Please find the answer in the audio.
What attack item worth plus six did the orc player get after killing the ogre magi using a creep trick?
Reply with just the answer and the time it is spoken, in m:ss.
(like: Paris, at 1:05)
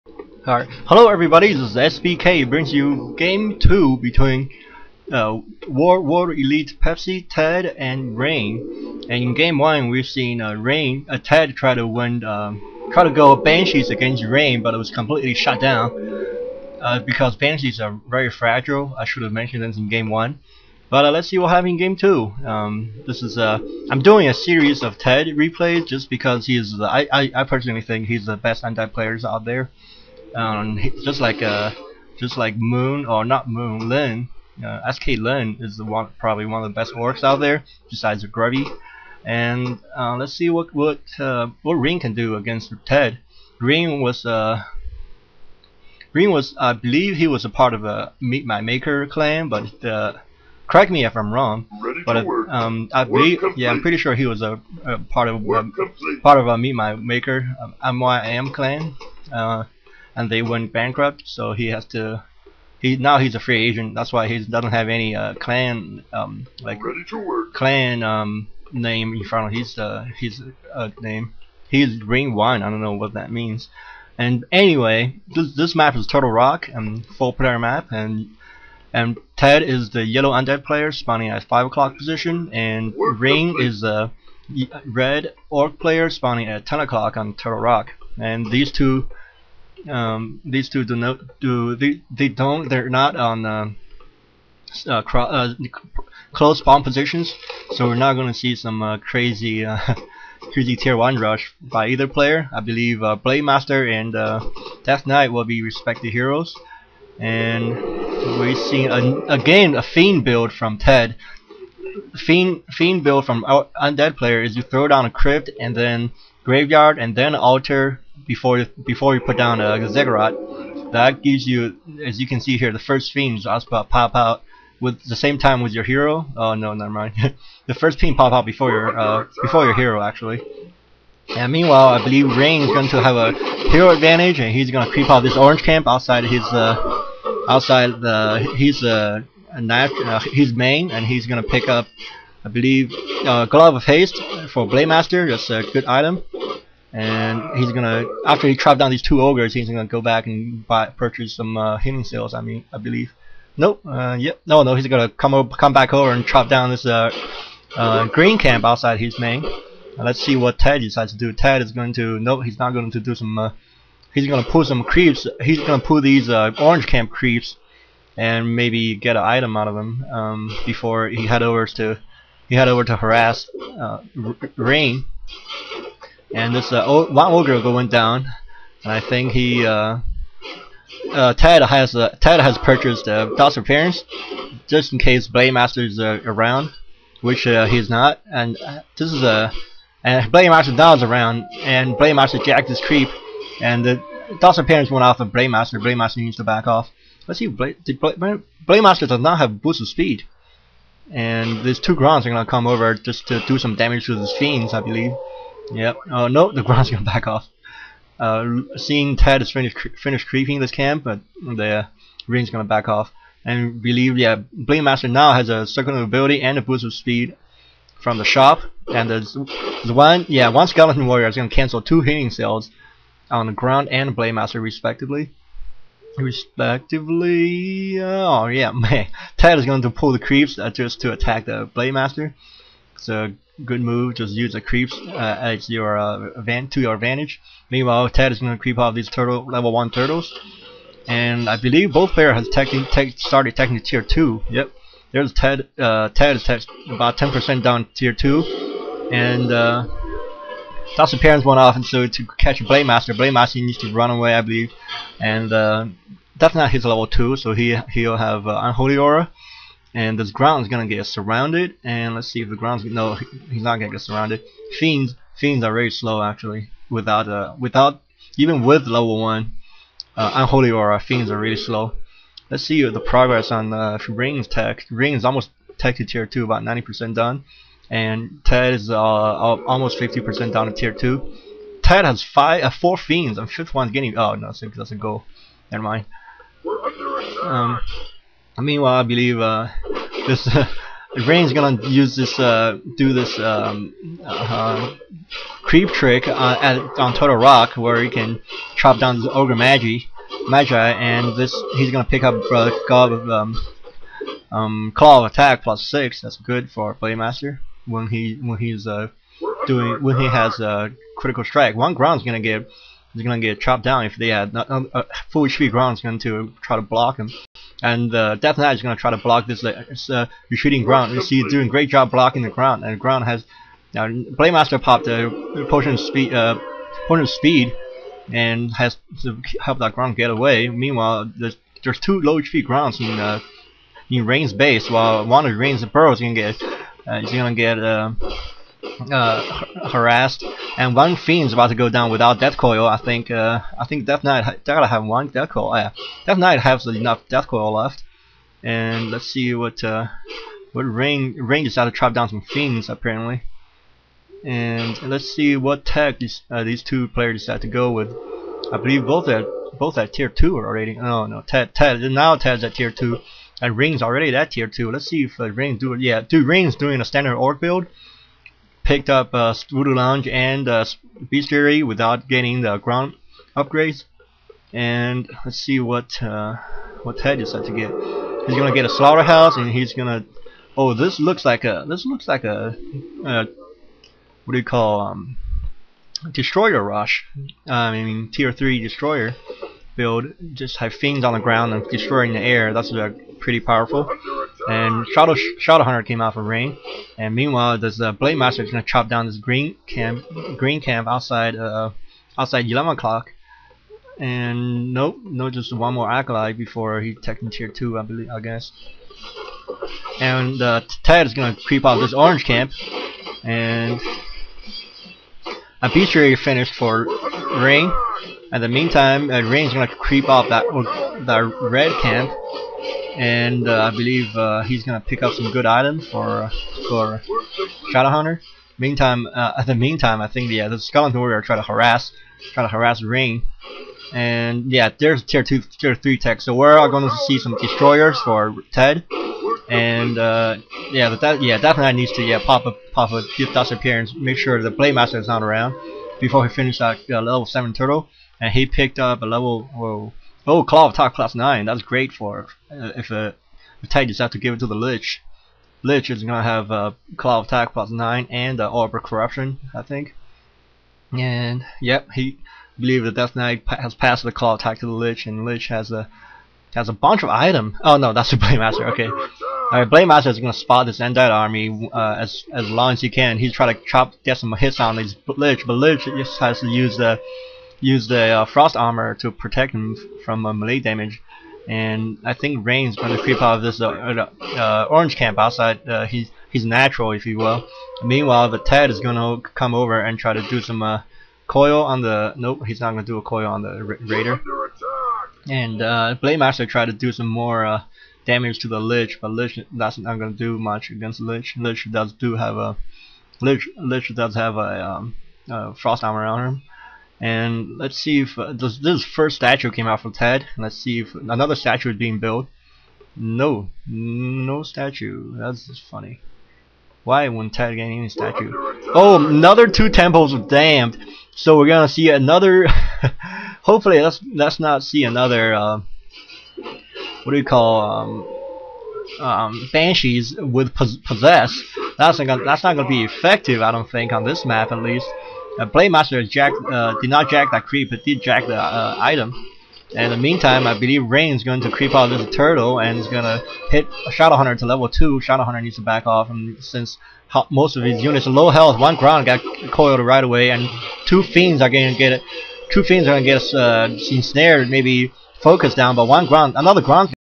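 Claw of Attack +6, at 5:04.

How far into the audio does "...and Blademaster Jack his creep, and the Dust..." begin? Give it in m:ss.
3:11.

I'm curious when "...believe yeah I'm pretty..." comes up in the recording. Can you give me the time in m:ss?
0:53.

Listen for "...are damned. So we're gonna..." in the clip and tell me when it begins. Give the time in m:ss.
8:40.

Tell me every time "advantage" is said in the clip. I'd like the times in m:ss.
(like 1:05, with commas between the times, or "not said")
2:13, 3:56.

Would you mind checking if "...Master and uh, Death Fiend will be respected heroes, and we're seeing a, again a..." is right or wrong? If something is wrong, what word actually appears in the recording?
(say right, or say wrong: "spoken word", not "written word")
wrong: "Knight", not "Fiend".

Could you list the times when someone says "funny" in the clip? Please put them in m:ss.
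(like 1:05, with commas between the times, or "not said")
8:35.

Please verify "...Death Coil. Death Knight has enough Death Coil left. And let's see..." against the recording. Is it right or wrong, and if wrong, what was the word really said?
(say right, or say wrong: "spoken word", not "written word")
right.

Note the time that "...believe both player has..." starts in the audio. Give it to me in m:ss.
4:01.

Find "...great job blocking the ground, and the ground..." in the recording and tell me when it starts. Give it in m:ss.
5:21.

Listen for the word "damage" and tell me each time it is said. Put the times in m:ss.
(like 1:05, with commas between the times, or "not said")
3:23, 8:00, 8:18.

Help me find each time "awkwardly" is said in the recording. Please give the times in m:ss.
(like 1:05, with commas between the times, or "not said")
not said.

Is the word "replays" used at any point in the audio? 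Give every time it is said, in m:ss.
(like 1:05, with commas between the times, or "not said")
0:25.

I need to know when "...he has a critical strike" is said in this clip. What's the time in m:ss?
5:10.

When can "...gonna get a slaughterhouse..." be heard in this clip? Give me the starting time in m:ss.
6:18.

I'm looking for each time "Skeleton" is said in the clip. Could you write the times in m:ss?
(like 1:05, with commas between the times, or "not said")
3:40, 7:10.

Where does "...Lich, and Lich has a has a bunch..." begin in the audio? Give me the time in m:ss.
7:44.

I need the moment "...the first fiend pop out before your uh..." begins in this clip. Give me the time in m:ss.
2:07.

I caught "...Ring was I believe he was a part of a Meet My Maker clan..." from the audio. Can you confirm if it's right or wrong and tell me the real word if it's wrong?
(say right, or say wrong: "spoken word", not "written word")
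right.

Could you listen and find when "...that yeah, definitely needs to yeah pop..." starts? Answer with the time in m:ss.
7:21.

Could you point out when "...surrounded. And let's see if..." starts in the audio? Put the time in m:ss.
4:21.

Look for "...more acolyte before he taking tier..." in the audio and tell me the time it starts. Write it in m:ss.
6:45.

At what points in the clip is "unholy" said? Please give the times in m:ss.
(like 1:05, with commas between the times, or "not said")
4:18, 4:30.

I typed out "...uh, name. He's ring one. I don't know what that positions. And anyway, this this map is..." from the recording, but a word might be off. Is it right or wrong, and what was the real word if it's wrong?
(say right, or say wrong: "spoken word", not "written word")
wrong: "means", not "positions".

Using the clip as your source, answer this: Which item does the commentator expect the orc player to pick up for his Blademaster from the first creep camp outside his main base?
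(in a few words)
Glove of Haste.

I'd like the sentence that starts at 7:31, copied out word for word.
That's great for uh, if uh, the Ted decides to give it to the Lich.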